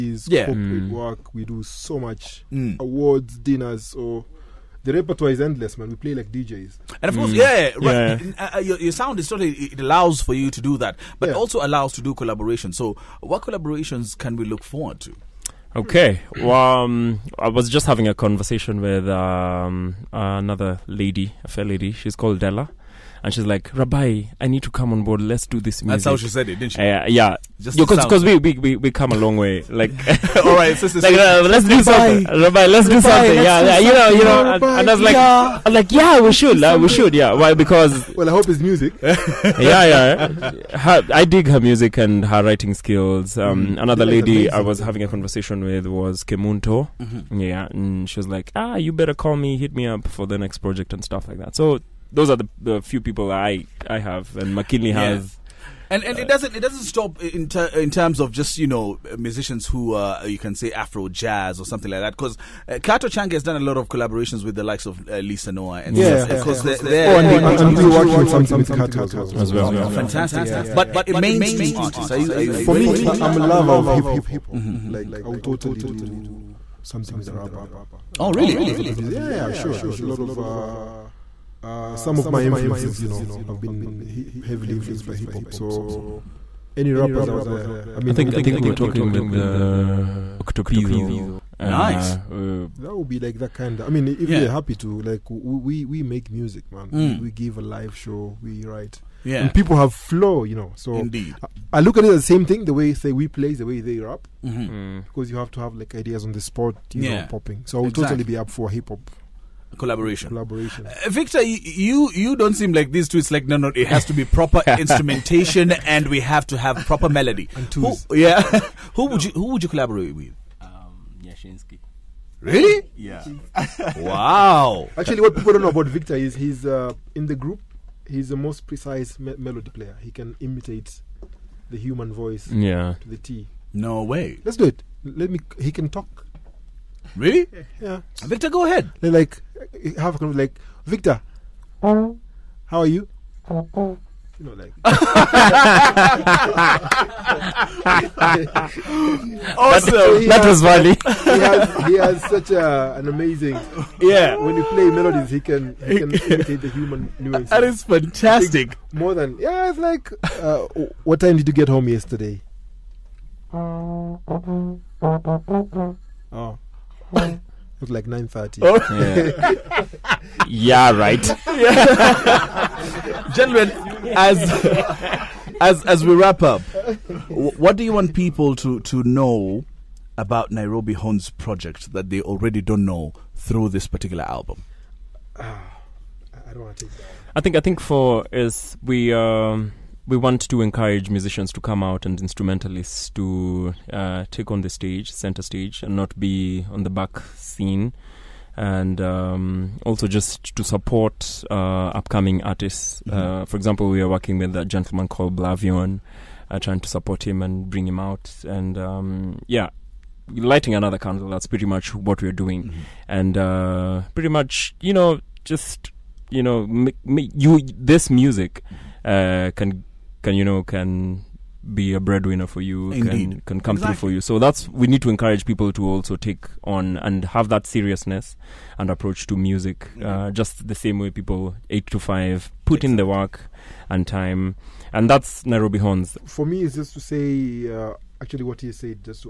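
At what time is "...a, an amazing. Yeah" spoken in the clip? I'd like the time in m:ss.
2:32.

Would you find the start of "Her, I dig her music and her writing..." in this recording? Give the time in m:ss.
0:40.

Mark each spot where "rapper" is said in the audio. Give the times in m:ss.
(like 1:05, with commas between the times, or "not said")
1:17, 1:26.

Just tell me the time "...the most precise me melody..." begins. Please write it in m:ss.
2:08.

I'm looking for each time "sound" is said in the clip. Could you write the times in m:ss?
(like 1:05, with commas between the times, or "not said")
0:08.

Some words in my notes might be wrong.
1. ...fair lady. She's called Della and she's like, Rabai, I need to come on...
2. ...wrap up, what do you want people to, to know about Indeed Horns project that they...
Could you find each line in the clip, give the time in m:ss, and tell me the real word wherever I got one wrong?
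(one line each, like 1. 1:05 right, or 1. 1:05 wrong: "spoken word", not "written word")
1. 0:21 right
2. 2:56 wrong: "Nairobi", not "Indeed".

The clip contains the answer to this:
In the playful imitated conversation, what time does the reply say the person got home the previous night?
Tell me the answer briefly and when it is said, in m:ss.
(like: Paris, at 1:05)
9:30, at 2:48.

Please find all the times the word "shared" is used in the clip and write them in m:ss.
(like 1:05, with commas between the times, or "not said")
not said.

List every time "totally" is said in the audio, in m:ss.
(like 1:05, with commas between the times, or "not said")
0:09, 1:15, 1:48.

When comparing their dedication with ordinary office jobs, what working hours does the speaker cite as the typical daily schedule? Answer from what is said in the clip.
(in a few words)
8 to 5.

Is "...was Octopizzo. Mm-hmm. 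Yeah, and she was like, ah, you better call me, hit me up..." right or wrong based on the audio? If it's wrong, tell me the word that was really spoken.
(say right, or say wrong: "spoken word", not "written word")
wrong: "Kemunto", not "Octopizzo".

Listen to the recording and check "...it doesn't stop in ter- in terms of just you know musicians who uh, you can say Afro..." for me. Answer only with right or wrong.
right.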